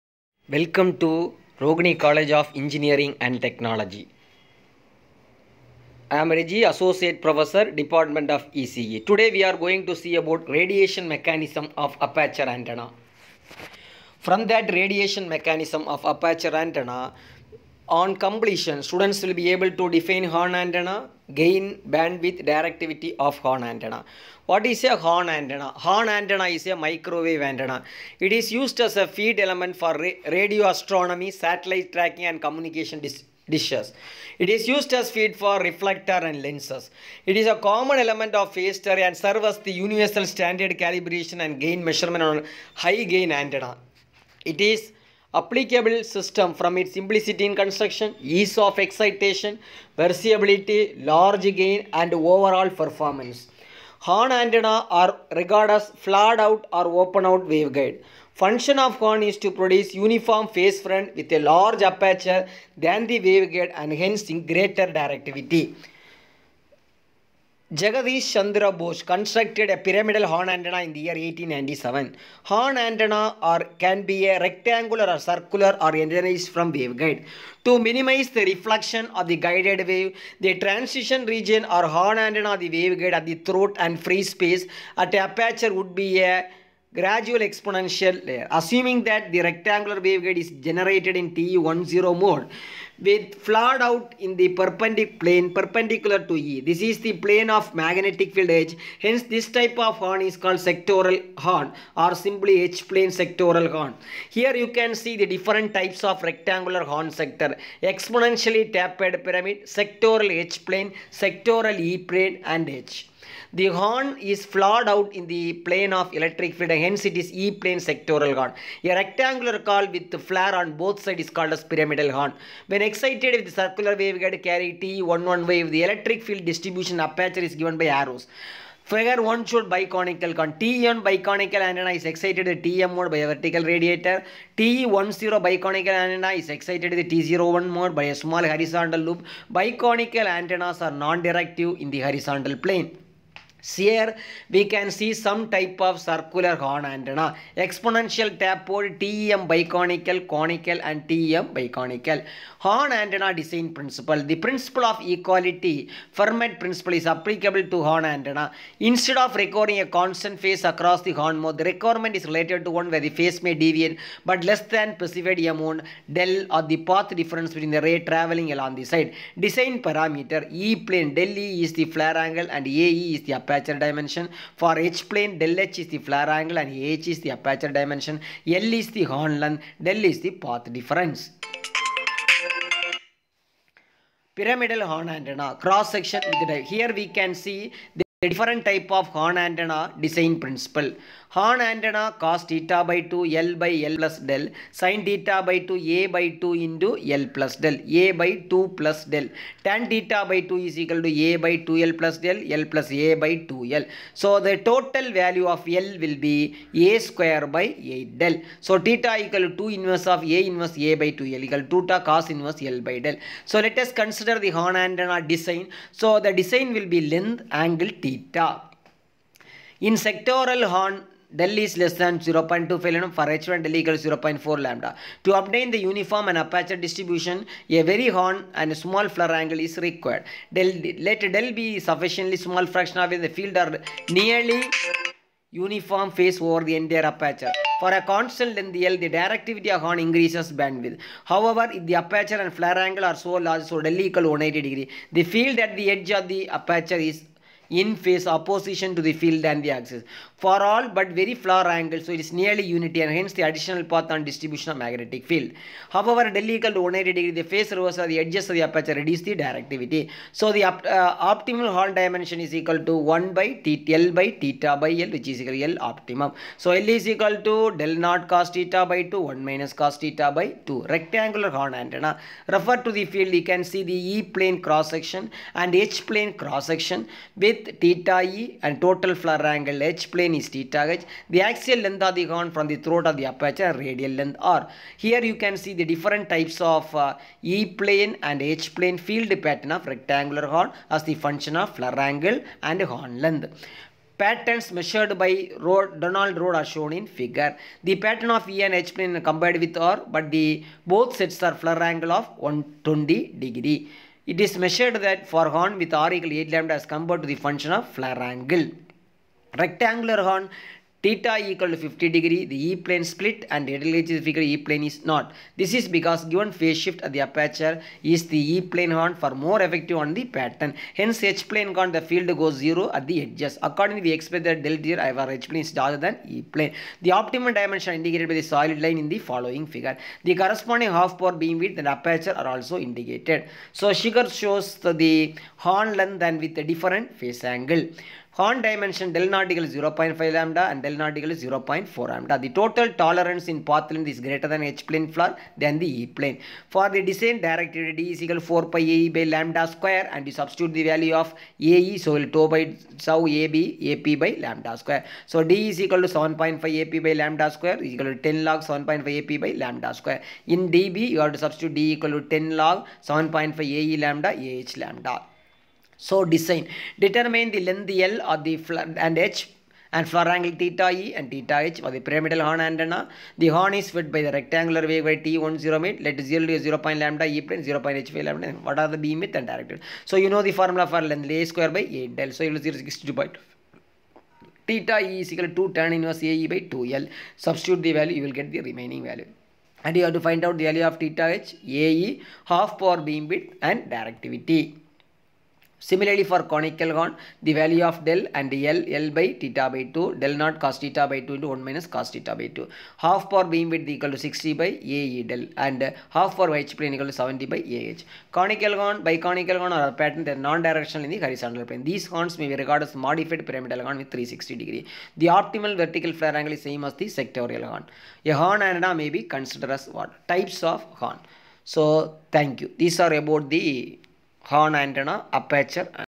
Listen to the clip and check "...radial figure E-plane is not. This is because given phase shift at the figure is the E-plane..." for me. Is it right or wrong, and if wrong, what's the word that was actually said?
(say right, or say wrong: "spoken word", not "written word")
wrong: "aperture", not "figure".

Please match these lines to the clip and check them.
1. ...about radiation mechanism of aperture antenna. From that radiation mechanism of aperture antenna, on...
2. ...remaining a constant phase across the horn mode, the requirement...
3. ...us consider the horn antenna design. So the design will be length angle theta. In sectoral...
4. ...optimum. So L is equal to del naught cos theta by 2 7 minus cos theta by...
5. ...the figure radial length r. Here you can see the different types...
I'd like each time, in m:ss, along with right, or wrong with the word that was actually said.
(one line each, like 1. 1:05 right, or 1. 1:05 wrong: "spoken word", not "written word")
1. 0:10 right
2. 2:39 wrong: "recording", not "remaining"
3. 3:33 right
4. 4:25 wrong: "1", not "7"
5. 4:43 wrong: "aperture", not "figure".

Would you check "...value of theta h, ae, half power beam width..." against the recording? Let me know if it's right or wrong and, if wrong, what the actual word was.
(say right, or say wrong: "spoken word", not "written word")
right.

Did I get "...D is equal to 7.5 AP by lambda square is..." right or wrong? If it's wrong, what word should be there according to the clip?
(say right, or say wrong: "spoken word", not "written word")
right.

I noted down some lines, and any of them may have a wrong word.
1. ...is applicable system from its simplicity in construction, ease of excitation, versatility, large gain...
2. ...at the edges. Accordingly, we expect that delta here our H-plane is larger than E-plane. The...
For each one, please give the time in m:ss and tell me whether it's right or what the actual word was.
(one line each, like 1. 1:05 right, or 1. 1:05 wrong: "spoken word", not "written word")
1. 0:44 right
2. 5:22 right.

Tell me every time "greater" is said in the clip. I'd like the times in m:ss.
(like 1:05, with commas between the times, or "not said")
1:04, 5:44.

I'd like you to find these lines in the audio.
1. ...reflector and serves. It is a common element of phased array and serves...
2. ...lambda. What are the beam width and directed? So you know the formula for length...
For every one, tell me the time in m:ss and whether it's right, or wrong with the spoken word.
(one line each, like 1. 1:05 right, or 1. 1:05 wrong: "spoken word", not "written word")
1. 0:35 wrong: "lenses", not "serves"
2. 6:18 right.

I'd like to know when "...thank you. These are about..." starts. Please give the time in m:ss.
7:02.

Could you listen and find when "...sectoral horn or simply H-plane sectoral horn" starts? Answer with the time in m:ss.
1:40.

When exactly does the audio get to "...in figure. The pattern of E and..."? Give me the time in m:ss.
4:56.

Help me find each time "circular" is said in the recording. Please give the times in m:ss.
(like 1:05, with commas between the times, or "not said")
1:15, 2:03, 2:26.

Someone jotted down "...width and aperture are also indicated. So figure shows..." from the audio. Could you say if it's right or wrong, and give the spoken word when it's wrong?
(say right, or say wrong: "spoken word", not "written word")
right.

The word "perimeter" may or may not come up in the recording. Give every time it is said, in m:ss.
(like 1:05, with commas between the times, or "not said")
not said.